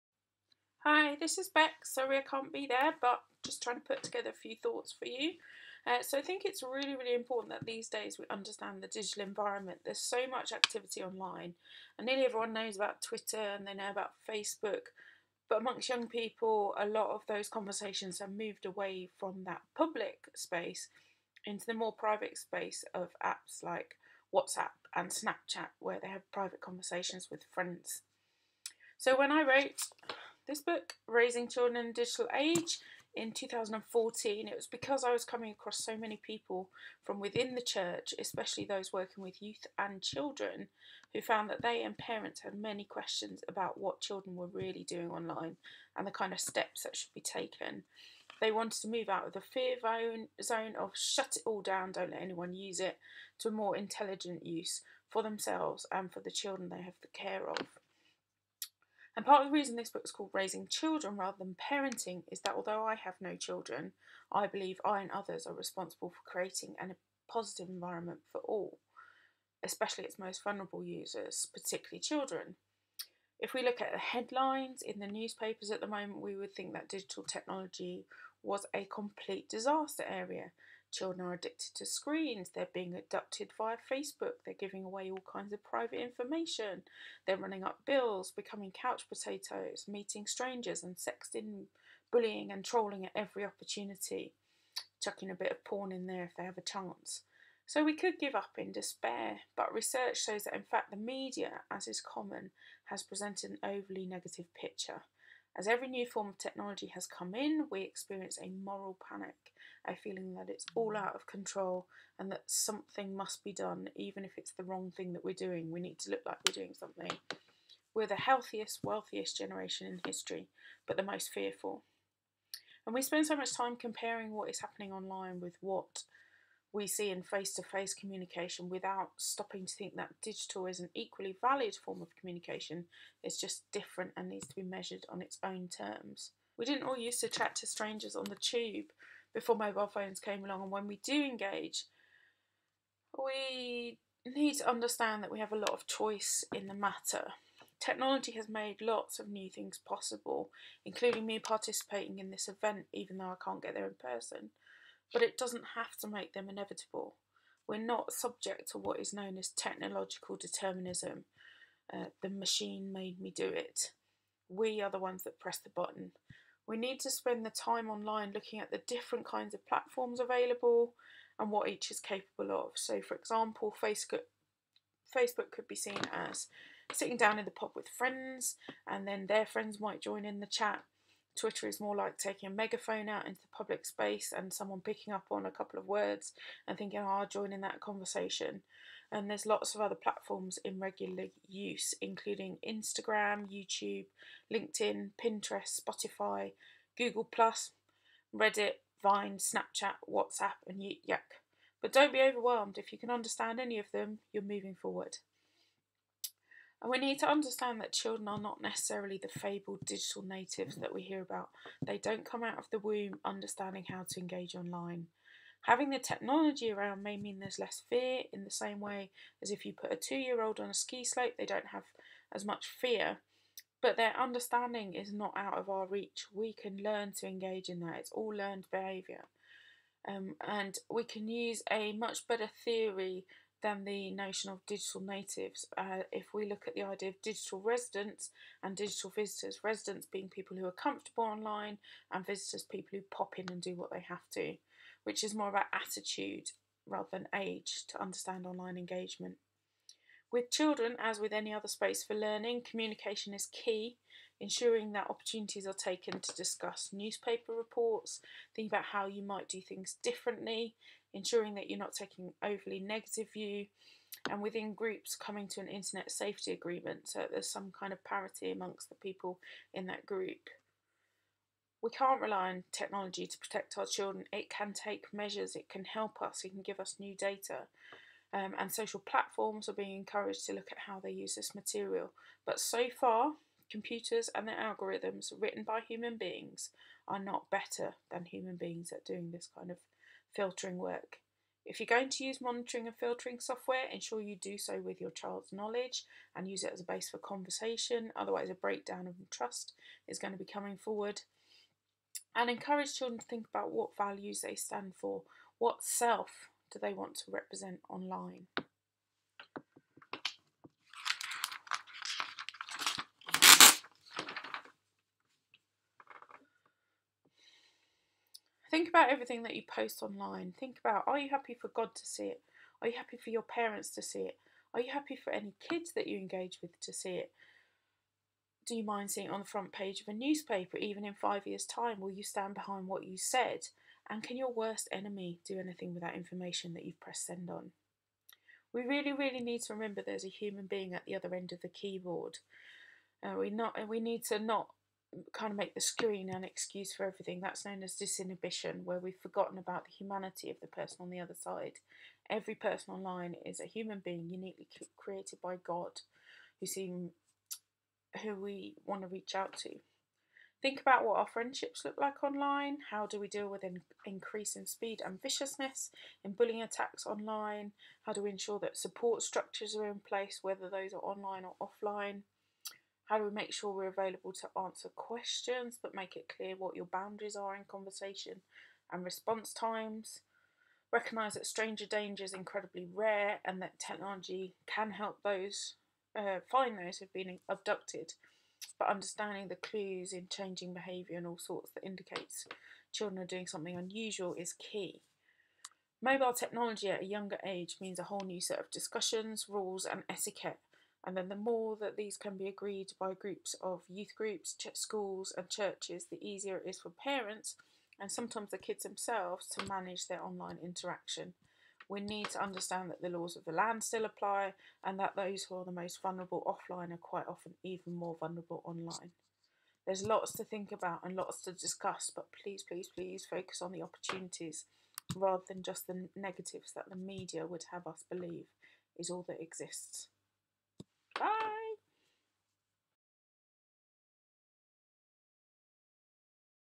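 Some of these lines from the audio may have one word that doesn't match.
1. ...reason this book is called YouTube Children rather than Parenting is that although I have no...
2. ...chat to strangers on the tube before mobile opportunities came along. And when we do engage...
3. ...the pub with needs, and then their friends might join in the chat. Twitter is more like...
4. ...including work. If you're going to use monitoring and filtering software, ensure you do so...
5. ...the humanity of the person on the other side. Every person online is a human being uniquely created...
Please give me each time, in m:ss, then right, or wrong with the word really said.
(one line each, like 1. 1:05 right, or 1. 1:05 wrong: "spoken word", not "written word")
1. 0:59 wrong: "Raising", not "YouTube"
2. 2:17 wrong: "phones", not "opportunities"
3. 2:57 wrong: "friends", not "needs"
4. 4:50 wrong: "filtering", not "including"
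5. 5:49 right.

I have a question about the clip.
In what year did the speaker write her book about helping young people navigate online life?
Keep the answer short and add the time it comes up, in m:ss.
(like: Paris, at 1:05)
2014, at 0:33.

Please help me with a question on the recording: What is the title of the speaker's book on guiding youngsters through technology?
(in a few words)
Raising Children in the Digital Age.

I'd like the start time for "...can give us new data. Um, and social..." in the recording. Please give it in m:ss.
4:36.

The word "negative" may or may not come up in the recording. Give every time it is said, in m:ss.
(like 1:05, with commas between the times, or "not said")
1:44, 4:22, 7:06.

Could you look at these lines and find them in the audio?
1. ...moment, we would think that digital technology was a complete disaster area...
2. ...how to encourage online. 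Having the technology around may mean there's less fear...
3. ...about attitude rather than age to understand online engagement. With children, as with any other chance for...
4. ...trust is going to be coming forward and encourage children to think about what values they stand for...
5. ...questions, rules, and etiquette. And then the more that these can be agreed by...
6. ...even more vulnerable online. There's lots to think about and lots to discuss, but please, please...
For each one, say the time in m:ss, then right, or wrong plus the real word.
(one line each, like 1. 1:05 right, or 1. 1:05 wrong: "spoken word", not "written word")
1. 1:15 right
2. 3:33 wrong: "engage", not "encourage"
3. 4:05 wrong: "space", not "chance"
4. 4:59 right
5. 6:38 wrong: "discussions", not "questions"
6. 6:57 right.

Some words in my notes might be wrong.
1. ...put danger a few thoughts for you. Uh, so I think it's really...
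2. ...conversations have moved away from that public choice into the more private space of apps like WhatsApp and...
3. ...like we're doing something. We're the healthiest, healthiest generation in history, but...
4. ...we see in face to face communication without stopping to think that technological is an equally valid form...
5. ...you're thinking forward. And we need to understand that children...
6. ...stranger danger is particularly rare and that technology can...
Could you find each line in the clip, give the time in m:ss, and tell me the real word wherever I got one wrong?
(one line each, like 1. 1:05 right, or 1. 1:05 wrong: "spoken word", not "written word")
1. 0:03 wrong: "together", not "danger"
2. 0:17 wrong: "space", not "choice"
3. 1:56 wrong: "wealthiest", not "healthiest"
4. 2:06 wrong: "digital", not "technological"
5. 3:24 wrong: "moving", not "thinking"
6. 6:21 wrong: "incredibly", not "particularly".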